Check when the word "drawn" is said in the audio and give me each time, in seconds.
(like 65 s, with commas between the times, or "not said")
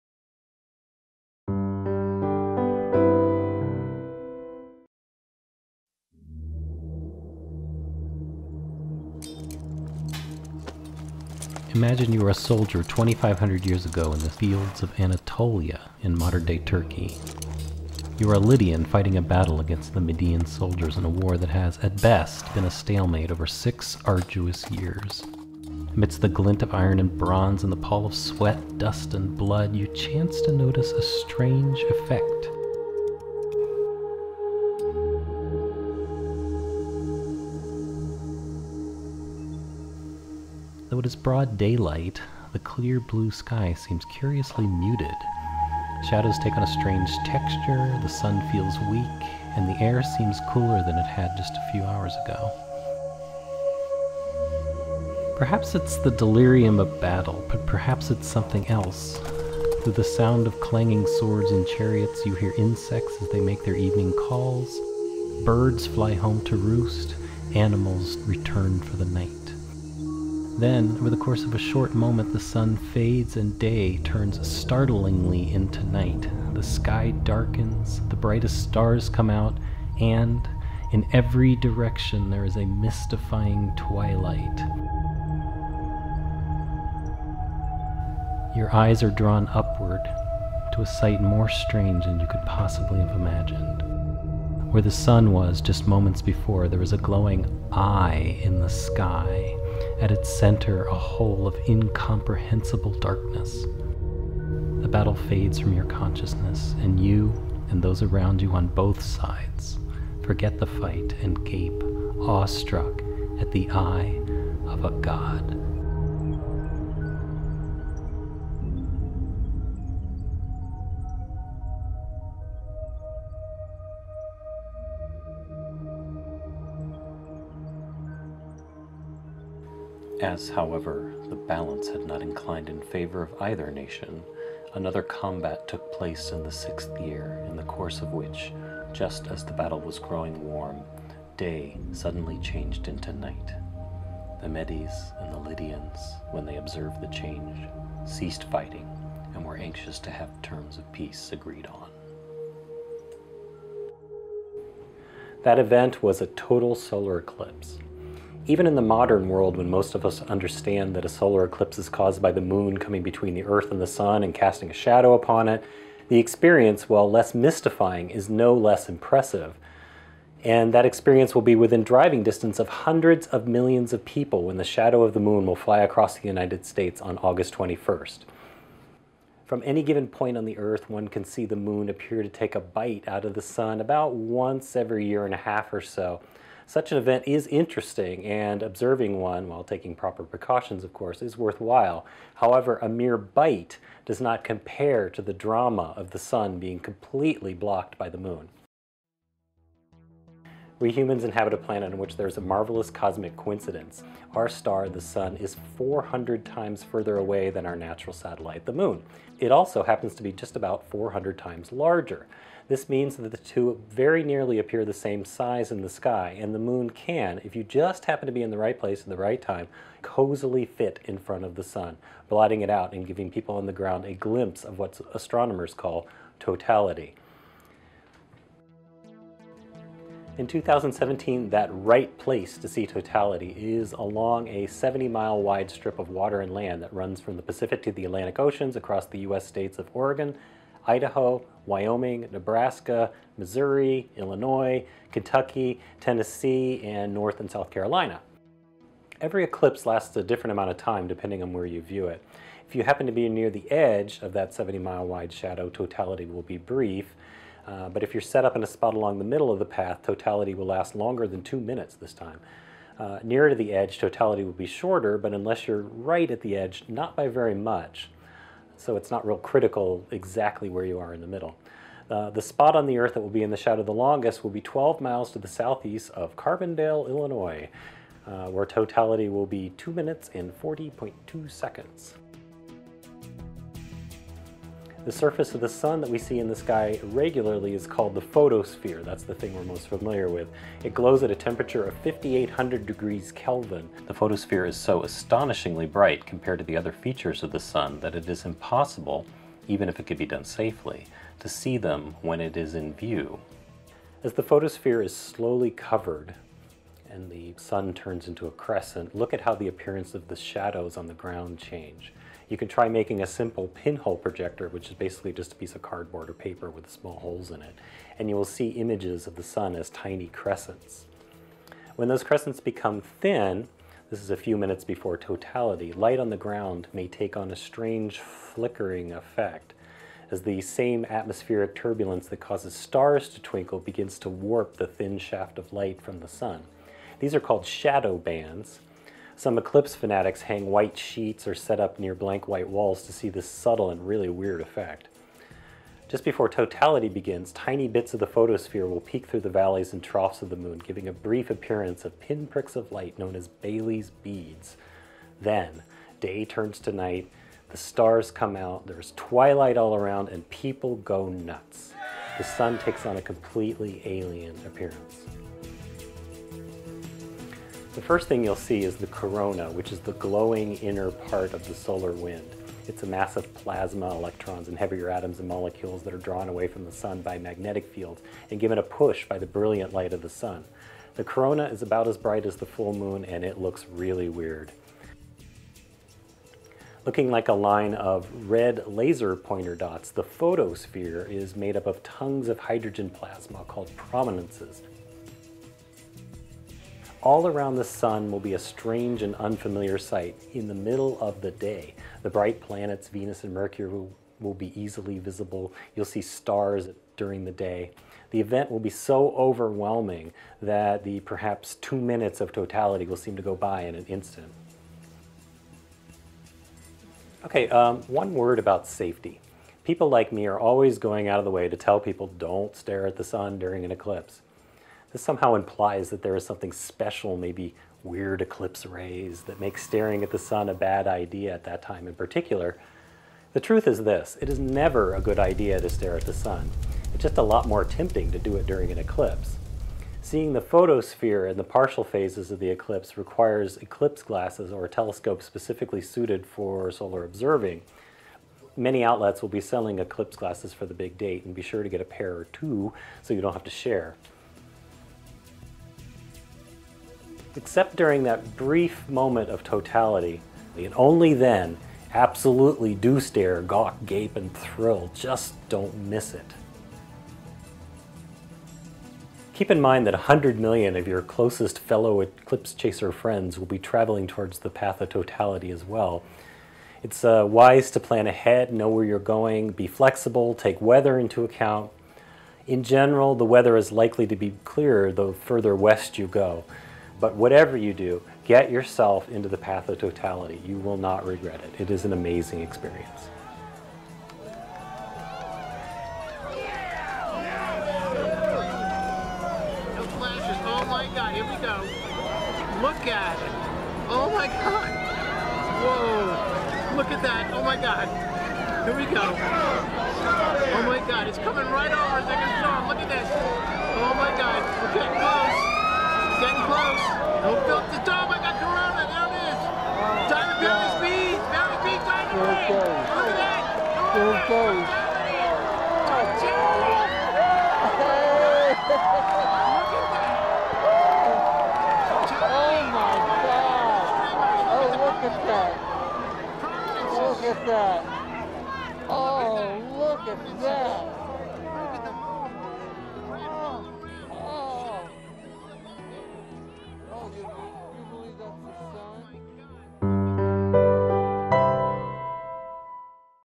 89 s, 376 s.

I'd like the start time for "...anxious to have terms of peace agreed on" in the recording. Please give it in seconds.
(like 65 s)
149 s.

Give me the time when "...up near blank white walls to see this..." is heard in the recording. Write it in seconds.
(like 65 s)
341 s.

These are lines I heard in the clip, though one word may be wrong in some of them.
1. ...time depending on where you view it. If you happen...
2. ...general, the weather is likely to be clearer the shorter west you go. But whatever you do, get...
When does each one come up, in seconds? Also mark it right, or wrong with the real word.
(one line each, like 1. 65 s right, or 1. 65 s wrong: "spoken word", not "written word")
1. 250 s right
2. 482 s wrong: "further", not "shorter".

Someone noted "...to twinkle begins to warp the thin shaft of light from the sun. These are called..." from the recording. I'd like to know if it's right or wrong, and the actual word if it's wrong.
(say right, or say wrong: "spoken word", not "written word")
right.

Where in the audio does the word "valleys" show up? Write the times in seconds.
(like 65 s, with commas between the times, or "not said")
349 s, 521 s.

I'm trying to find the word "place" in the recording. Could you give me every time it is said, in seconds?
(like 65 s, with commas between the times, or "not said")
135 s, 218 s, 232 s.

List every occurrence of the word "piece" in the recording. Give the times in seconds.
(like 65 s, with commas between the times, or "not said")
315 s.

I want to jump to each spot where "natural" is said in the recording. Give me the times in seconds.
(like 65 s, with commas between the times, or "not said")
207 s.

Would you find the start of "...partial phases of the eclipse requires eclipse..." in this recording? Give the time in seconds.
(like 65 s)
441 s.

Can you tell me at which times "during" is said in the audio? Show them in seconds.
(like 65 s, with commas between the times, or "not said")
407 s, 423 s, 438 s, 457 s.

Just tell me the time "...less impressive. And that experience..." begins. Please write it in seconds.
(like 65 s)
168 s.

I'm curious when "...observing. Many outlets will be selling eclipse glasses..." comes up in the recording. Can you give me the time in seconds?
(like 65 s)
447 s.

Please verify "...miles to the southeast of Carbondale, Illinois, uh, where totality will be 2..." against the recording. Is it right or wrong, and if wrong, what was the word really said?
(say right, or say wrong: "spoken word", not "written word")
right.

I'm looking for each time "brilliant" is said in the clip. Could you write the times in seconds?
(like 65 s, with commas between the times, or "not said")
379 s.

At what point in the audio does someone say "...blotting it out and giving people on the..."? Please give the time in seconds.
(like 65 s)
222 s.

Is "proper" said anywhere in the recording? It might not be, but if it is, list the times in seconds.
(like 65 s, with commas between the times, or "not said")
189 s.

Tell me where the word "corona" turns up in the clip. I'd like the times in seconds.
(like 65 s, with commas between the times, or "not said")
369 s, 381 s, 518 s.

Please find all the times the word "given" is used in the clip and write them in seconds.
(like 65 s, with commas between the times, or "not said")
179 s, 378 s.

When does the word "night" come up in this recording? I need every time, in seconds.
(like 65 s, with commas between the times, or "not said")
69 s, 75 s, 143 s, 356 s.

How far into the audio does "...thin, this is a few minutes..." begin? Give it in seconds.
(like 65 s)
322 s.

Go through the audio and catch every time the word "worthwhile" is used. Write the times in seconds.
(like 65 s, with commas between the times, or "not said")
191 s.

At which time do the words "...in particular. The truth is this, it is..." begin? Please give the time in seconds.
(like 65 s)
432 s.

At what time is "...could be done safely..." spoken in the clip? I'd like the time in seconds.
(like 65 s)
300 s.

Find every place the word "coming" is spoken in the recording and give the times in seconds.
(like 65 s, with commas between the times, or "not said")
162 s, 511 s.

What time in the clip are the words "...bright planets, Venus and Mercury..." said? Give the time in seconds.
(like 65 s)
402 s.